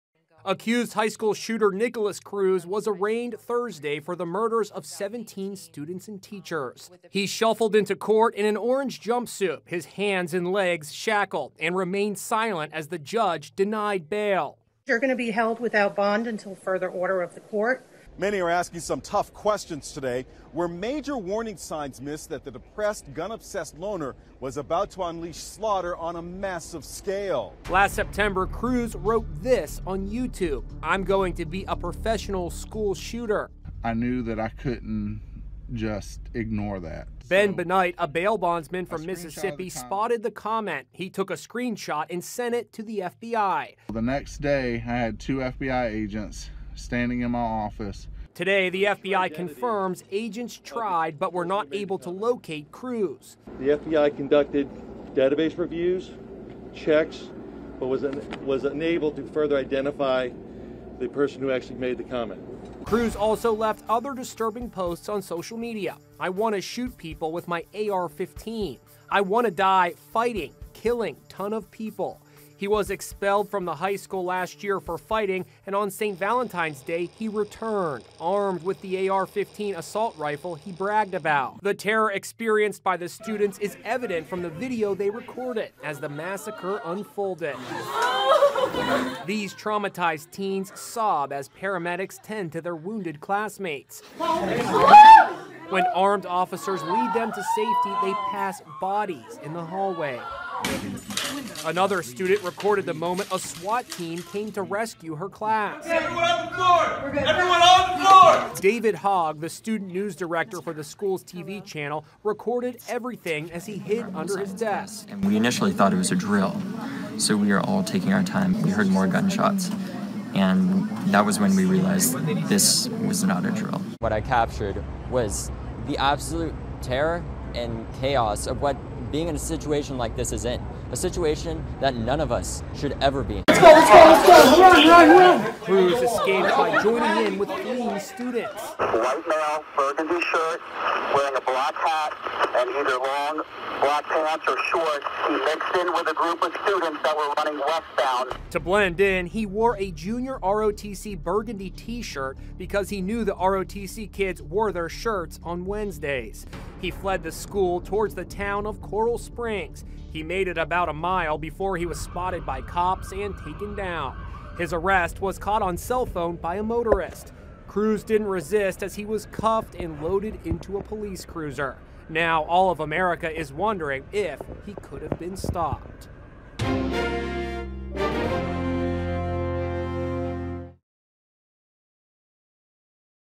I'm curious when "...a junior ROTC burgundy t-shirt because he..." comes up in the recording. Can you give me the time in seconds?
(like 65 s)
149 s.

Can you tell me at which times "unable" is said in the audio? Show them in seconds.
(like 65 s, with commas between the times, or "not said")
58 s.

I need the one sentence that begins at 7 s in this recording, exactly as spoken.
He shuffled into court in an orange jumpsuit, his hands and legs shackled, and remained silent as the judge denied bail.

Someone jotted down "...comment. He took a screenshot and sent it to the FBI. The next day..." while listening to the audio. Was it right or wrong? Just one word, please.
right.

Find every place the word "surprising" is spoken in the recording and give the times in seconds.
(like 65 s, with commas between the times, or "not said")
not said.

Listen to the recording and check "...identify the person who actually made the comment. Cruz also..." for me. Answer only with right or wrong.
right.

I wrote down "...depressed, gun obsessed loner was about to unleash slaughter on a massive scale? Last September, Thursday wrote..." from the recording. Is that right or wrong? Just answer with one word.
wrong.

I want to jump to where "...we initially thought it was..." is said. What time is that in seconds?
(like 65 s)
115 s.